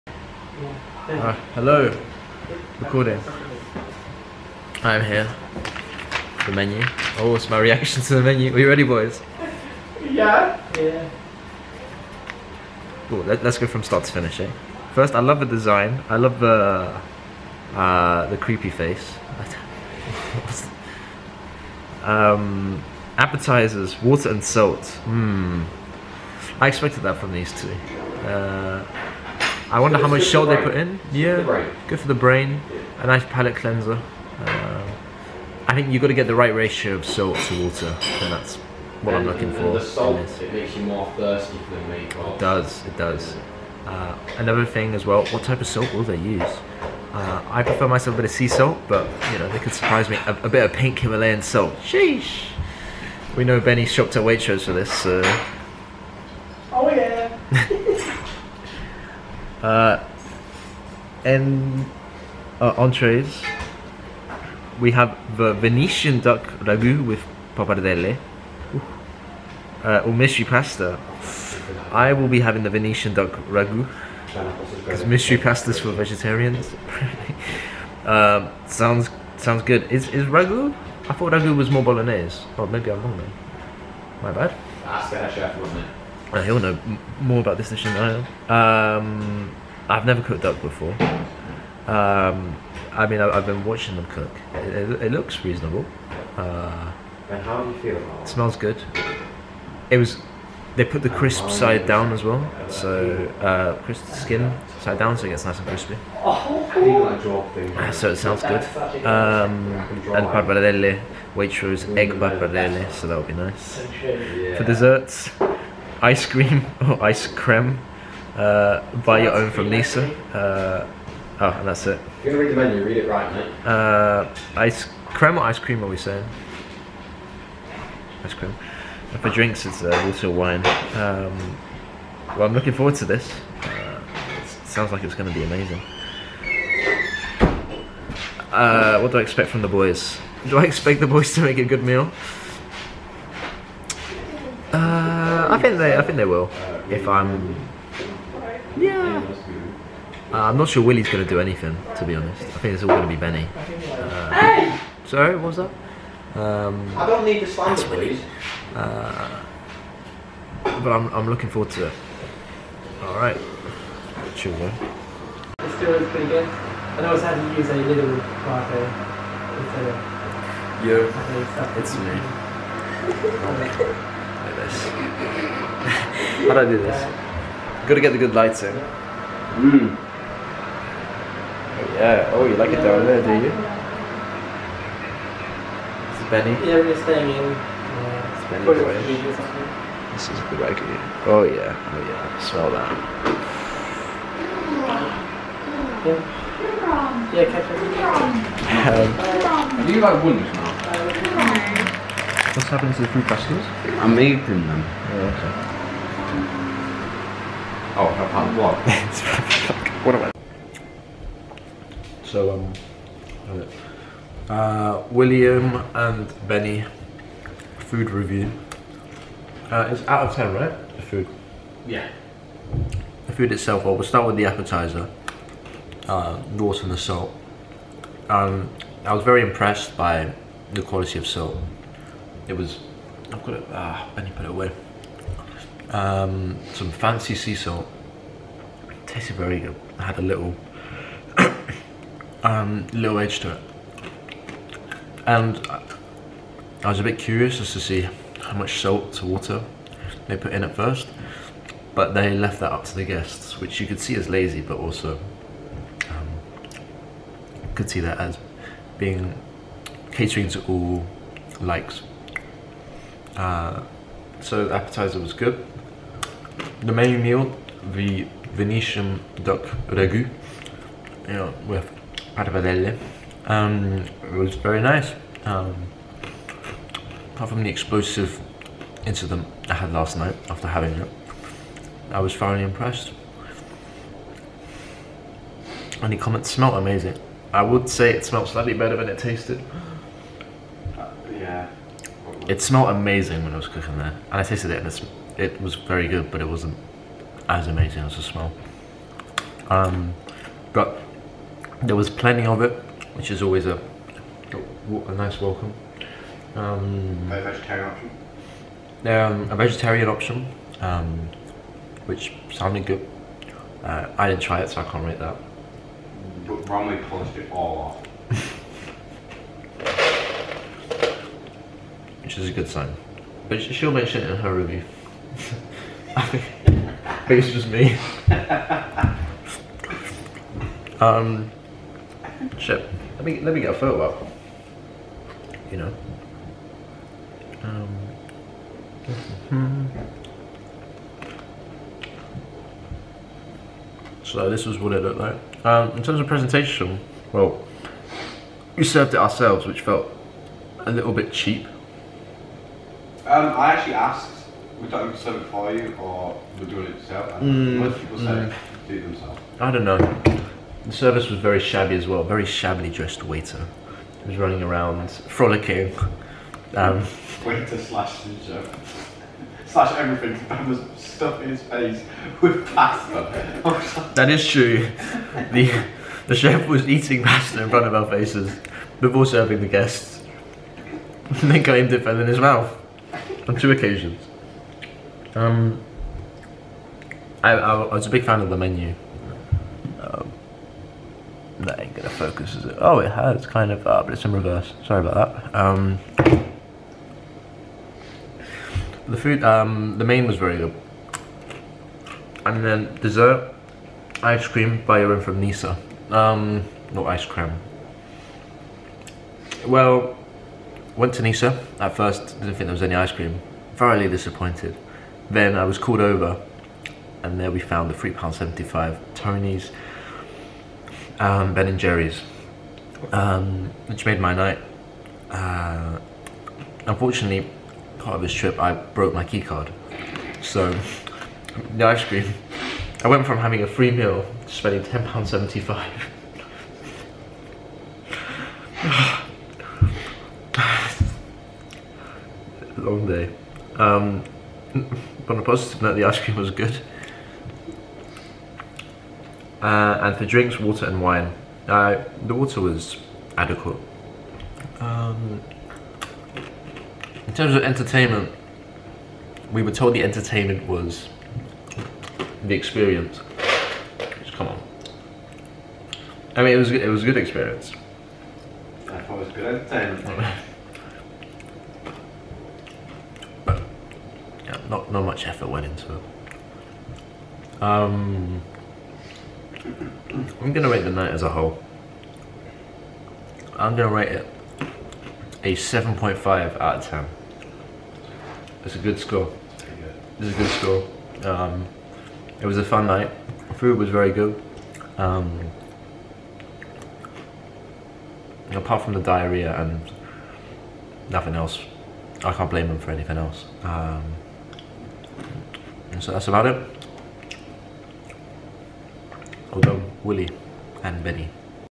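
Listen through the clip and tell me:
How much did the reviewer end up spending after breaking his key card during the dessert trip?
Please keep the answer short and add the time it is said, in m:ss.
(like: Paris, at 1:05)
£10.75, at 7:14.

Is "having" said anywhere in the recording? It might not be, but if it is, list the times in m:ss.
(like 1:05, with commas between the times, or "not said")
1:12, 4:40, 7:13.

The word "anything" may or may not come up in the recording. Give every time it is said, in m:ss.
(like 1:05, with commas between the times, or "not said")
2:31, 8:22.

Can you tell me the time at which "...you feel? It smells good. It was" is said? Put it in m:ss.
1:37.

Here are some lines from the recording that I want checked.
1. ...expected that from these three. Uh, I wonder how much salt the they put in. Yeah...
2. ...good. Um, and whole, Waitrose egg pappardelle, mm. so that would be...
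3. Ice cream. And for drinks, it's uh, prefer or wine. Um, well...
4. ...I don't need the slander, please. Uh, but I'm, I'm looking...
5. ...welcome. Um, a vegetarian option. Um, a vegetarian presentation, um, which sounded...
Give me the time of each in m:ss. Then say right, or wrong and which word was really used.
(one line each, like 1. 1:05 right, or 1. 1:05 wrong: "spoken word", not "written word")
1. 0:26 wrong: "two", not "three"
2. 1:48 wrong: "pappardelle", not "whole"
3. 2:08 wrong: "water", not "prefer"
4. 2:36 right
5. 5:05 wrong: "option", not "presentation".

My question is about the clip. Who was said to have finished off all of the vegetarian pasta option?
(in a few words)
Bromley.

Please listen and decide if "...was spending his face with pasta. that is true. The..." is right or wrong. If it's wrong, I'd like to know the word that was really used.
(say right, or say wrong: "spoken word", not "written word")
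wrong: "stuffing", not "spending".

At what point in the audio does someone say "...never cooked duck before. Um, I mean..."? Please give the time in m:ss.
1:30.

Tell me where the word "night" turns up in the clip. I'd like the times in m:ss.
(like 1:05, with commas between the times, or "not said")
4:40, 7:04, 8:00, 8:12.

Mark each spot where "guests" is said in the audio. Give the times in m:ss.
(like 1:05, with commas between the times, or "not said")
4:13, 6:19.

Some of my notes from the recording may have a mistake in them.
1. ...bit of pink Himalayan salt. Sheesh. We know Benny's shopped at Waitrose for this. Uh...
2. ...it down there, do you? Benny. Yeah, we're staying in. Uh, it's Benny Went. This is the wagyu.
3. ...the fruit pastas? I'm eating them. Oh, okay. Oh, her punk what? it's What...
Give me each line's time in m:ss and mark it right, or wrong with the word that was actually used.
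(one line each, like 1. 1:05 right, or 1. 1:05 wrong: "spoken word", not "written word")
1. 0:50 right
2. 3:02 wrong: "Boy", not "Went"
3. 3:23 right.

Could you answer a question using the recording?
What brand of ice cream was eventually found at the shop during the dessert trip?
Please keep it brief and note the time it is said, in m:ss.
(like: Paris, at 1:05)
Ben and Jerry's, at 7:01.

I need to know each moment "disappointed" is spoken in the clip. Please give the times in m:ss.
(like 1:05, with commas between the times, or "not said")
6:54.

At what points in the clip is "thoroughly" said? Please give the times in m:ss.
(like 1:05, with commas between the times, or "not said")
4:42, 6:53.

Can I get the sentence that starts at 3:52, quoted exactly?
It was, I've got it, ah, Benny put it away um, some fancy sea salt.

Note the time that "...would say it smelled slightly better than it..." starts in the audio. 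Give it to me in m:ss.
4:47.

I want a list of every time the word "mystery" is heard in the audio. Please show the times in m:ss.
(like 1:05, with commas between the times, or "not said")
1:10, 1:15.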